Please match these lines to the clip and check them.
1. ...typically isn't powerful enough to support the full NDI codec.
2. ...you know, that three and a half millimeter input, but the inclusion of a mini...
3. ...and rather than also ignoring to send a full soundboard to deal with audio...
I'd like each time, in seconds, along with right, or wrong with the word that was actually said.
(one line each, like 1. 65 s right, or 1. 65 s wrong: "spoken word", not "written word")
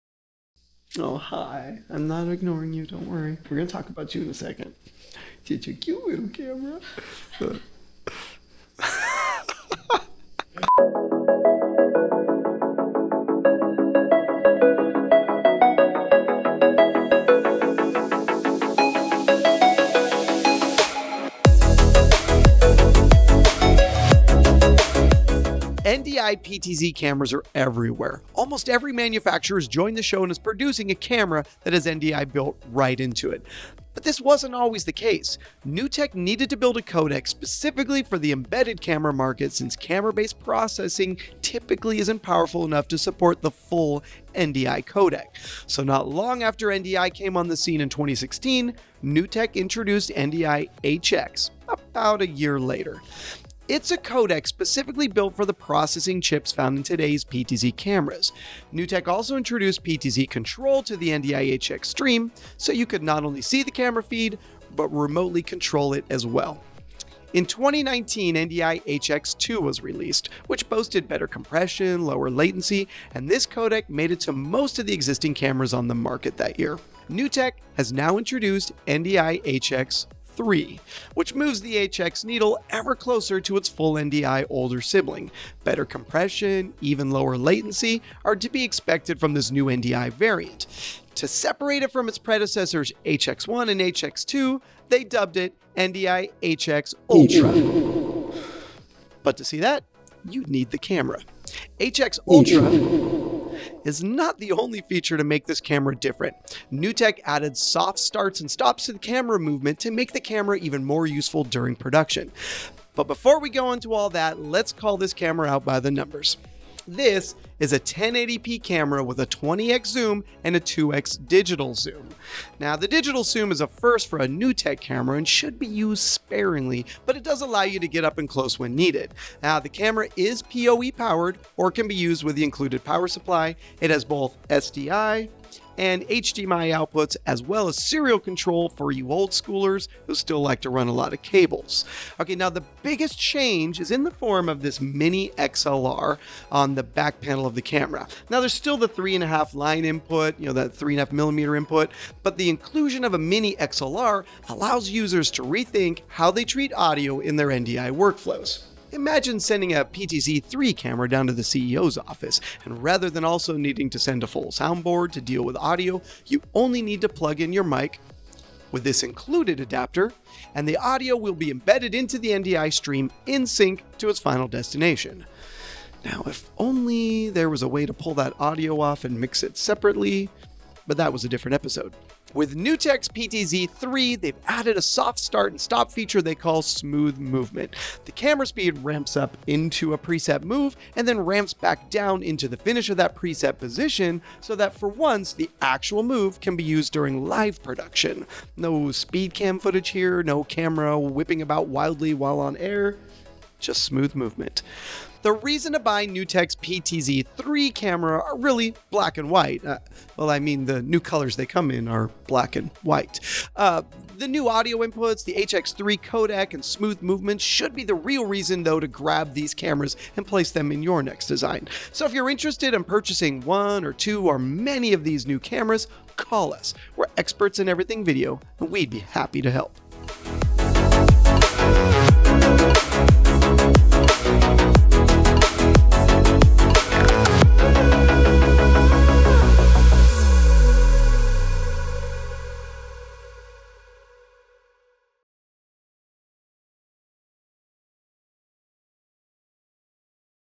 1. 41 s right
2. 150 s right
3. 162 s wrong: "needing", not "ignoring".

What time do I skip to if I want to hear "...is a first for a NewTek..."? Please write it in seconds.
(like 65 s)
123 s.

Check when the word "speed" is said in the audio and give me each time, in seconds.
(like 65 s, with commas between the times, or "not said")
188 s, 198 s.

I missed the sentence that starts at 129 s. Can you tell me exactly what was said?
Now, the camera is PoE powered or can be used with the included power supply.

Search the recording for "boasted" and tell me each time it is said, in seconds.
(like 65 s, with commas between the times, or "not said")
70 s.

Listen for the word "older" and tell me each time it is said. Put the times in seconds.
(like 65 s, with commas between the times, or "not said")
84 s.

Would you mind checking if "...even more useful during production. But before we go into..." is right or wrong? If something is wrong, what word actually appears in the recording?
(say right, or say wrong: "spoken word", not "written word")
right.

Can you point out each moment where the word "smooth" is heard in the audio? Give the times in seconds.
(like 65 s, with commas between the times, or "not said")
186 s, 203 s, 216 s.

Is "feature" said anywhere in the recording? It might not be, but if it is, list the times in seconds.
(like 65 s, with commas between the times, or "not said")
104 s, 185 s.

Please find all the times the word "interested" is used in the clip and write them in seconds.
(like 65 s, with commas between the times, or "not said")
222 s.